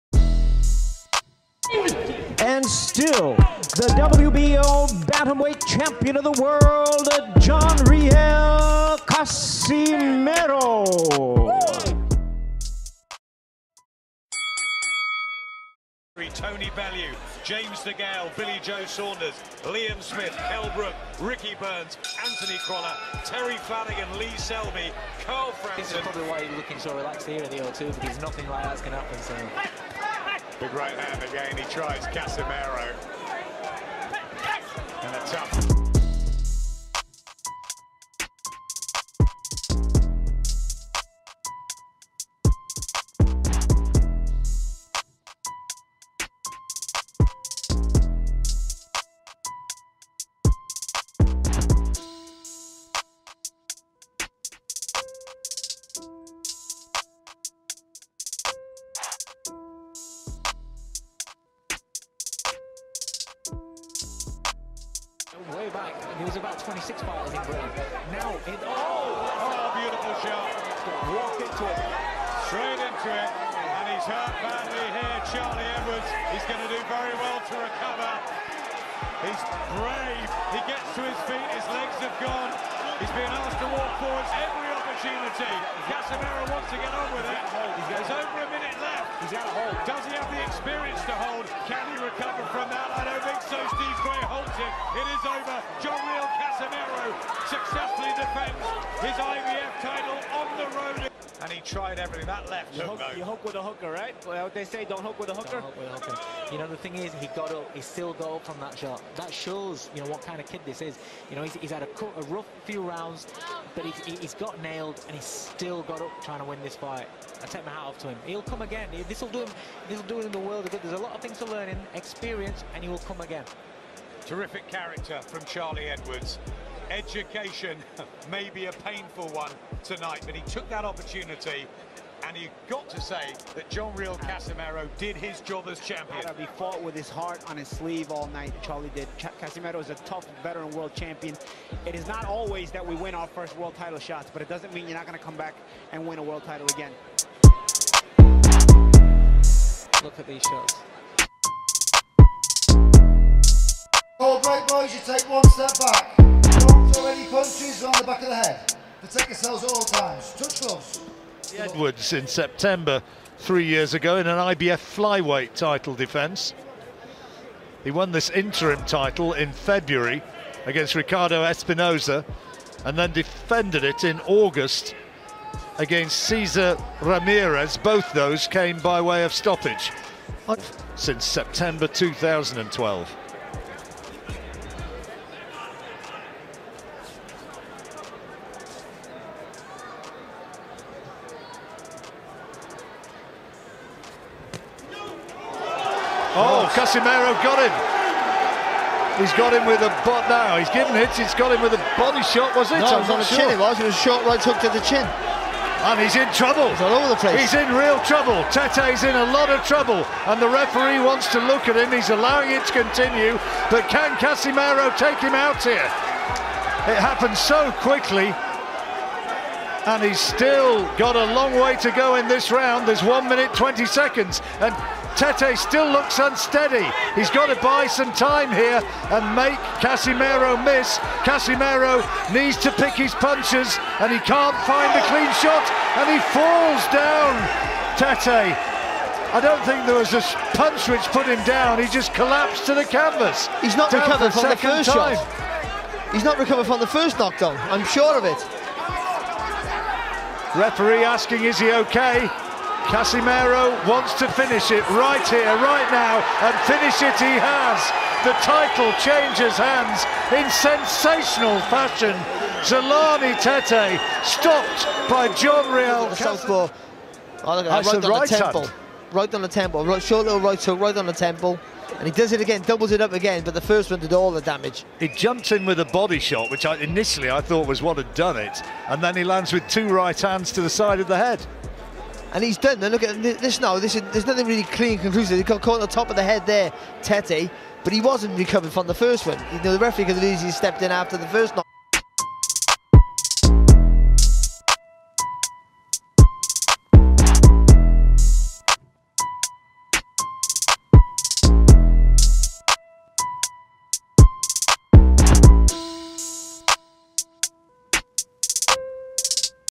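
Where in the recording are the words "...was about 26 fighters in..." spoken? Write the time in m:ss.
1:06.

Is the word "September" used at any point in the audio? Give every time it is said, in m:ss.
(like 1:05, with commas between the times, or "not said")
2:42, 3:01.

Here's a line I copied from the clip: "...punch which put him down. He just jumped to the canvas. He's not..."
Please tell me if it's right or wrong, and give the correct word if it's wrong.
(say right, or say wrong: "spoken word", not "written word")
wrong: "collapsed", not "jumped".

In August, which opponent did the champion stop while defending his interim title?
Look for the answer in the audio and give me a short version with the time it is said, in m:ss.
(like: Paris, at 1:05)
Cesar Ramirez, at 2:56.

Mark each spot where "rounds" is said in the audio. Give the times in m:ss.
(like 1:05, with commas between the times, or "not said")
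1:52, 3:42.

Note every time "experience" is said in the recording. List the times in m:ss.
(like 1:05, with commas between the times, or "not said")
1:30, 2:01.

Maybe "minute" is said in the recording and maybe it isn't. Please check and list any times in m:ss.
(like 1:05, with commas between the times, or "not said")
1:28, 3:43.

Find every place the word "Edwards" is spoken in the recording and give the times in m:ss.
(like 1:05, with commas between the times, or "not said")
1:15, 2:05, 2:41.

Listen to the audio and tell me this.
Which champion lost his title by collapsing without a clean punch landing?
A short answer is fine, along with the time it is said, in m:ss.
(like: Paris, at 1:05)
Zolani Tete, at 4:22.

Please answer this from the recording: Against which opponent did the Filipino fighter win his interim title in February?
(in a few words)
Ricardo Espinoza.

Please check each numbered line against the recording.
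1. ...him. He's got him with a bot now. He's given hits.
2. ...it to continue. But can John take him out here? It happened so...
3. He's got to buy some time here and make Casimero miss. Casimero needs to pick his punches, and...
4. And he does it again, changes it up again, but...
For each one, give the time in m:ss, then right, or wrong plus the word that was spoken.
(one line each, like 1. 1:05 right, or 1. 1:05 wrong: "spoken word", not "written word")
1. 3:17 right
2. 3:32 wrong: "Casimero", not "John"
3. 3:47 right
4. 4:31 wrong: "doubles", not "changes".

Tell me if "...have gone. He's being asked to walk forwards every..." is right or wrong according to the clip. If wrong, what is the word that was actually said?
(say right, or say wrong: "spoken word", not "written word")
right.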